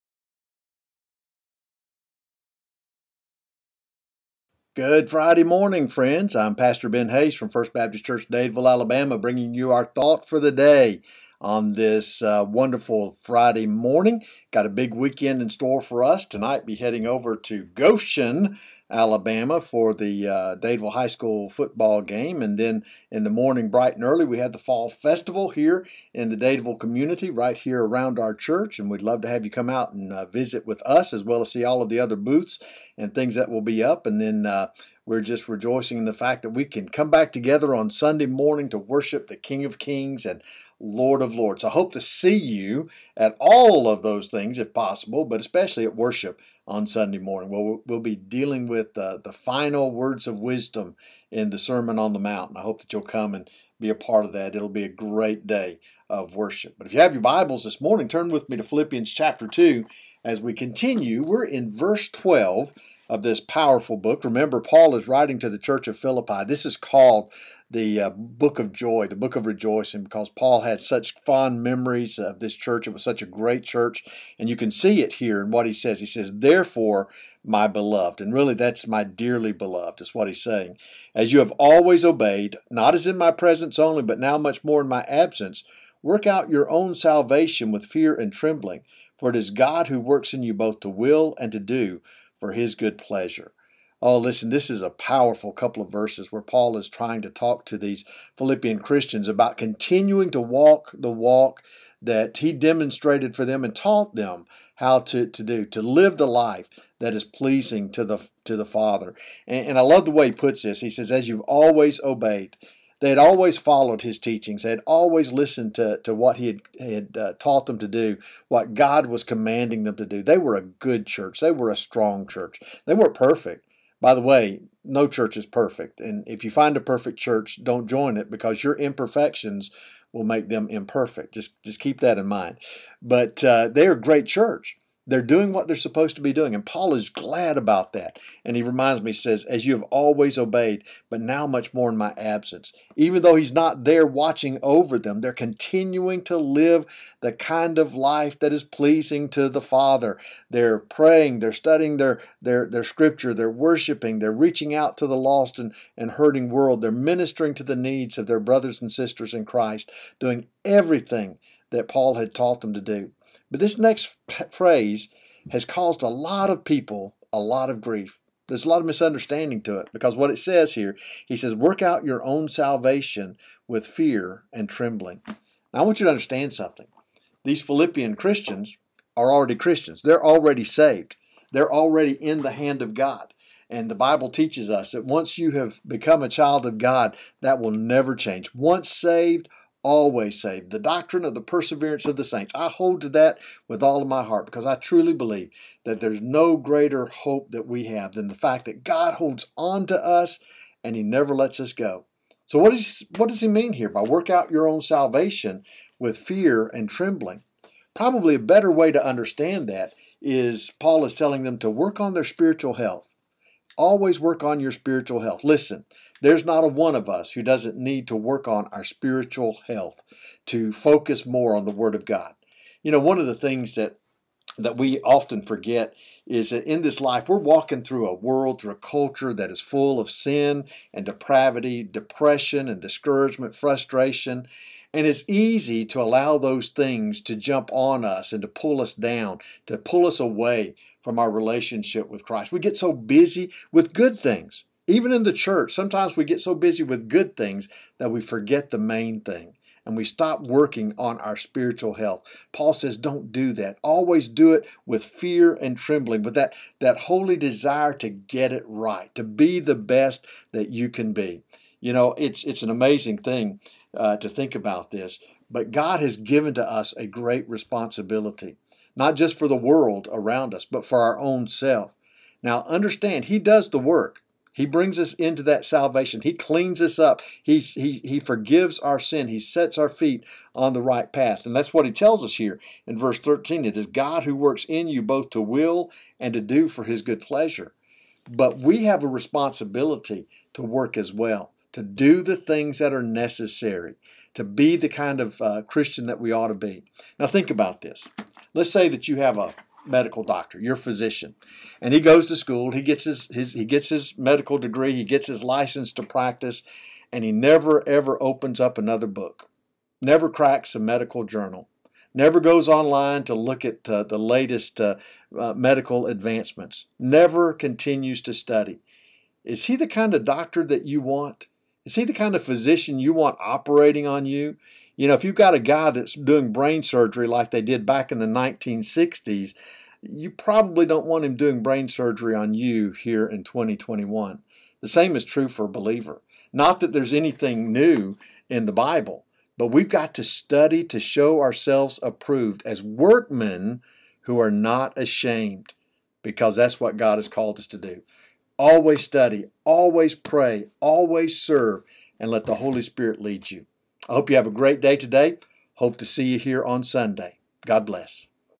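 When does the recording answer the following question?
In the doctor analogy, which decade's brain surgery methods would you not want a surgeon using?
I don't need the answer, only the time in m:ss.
5:28.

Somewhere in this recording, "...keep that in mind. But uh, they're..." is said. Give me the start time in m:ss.
2:11.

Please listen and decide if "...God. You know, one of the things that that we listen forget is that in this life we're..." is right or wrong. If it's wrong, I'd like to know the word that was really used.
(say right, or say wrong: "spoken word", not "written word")
wrong: "often", not "listen".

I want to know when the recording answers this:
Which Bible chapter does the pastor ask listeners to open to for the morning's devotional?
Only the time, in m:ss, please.
0:58.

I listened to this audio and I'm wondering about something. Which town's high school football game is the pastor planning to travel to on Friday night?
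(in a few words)
Goshen.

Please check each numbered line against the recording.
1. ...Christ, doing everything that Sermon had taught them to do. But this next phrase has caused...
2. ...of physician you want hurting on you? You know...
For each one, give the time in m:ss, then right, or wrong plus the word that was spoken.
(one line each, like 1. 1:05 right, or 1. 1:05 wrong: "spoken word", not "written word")
1. 2:39 wrong: "Paul", not "Sermon"
2. 5:22 wrong: "operating", not "hurting".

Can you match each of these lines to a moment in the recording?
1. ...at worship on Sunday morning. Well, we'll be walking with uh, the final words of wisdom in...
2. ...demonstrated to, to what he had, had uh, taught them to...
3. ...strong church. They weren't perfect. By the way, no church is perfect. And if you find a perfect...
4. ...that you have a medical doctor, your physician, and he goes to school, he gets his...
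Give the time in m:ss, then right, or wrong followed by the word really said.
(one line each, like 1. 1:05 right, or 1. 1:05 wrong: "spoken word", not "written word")
1. 0:45 wrong: "dealing", not "walking"
2. 1:55 wrong: "listened", not "demonstrated"
3. 2:01 right
4. 4:58 right.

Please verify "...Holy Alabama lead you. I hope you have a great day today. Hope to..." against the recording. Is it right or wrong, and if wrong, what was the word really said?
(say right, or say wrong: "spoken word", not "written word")
wrong: "Spirit", not "Alabama".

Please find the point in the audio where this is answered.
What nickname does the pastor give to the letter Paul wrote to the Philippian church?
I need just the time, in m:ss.
1:08.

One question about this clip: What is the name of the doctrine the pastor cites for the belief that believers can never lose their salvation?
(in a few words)
Perseverance of the saints.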